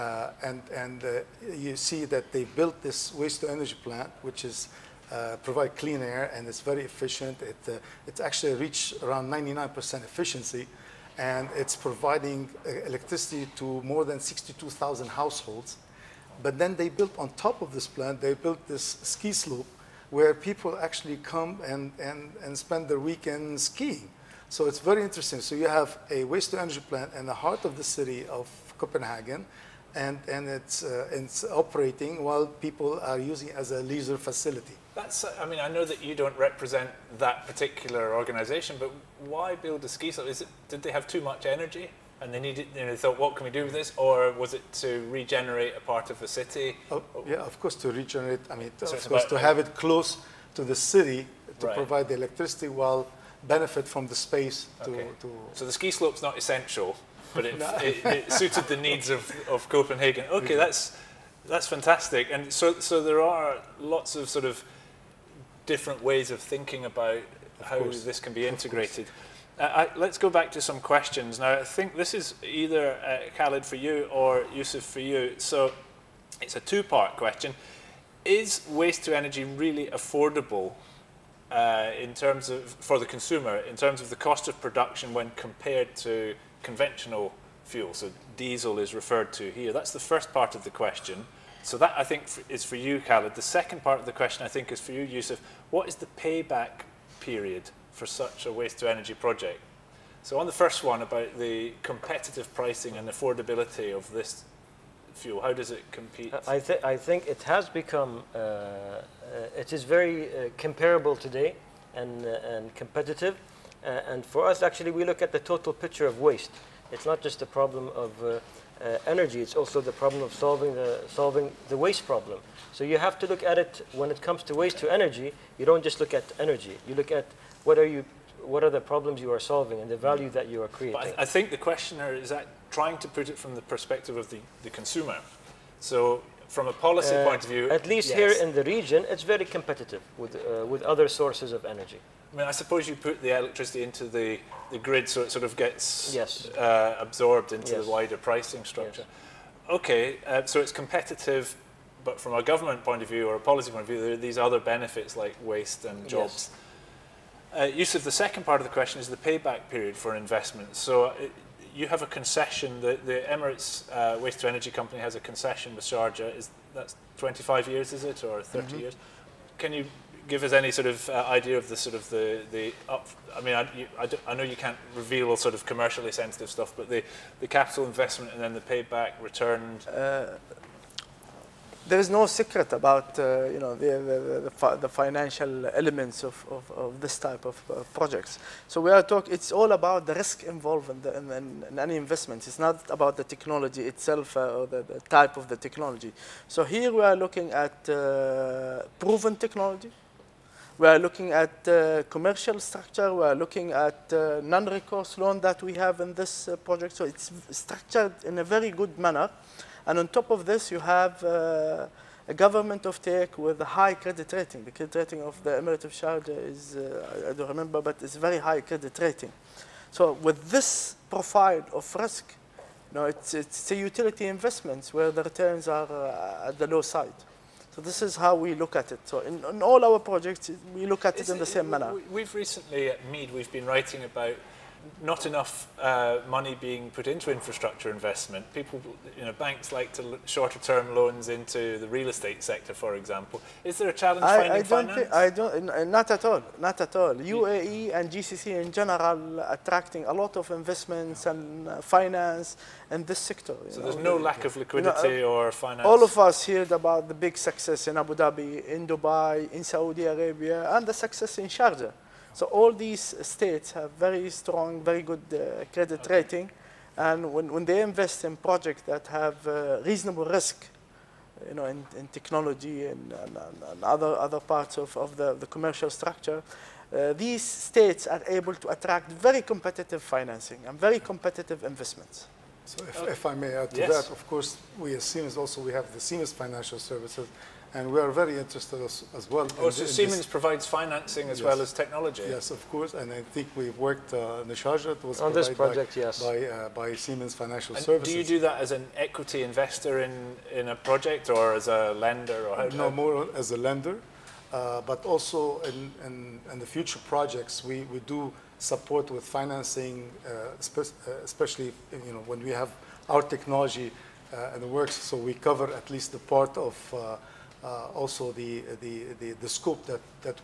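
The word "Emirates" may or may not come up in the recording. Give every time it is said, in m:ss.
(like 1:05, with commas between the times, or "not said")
2:43, 3:35.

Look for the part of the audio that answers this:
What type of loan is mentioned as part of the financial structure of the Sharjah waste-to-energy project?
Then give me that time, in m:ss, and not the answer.
3:24.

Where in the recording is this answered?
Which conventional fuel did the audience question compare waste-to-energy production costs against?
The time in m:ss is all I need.
1:28.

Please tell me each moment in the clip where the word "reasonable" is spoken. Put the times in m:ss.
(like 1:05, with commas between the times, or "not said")
4:29.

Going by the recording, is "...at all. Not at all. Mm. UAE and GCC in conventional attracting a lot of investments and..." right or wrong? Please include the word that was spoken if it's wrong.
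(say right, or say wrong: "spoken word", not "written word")
wrong: "general", not "conventional".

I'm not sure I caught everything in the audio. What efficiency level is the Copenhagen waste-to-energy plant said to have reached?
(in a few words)
99%.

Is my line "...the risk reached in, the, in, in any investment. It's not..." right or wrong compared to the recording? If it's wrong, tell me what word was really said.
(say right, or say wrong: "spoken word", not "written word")
wrong: "involved", not "reached".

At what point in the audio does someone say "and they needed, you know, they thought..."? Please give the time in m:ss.
0:42.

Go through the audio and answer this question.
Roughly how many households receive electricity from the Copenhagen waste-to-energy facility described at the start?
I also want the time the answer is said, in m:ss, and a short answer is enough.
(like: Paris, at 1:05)
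62,000, at 0:14.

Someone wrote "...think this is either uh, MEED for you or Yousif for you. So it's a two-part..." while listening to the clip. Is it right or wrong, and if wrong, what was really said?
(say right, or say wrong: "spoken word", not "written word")
wrong: "Khaled", not "MEED".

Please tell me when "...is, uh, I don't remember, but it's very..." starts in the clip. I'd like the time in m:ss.
3:36.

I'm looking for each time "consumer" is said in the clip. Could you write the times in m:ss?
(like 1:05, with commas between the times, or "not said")
1:23, 2:14.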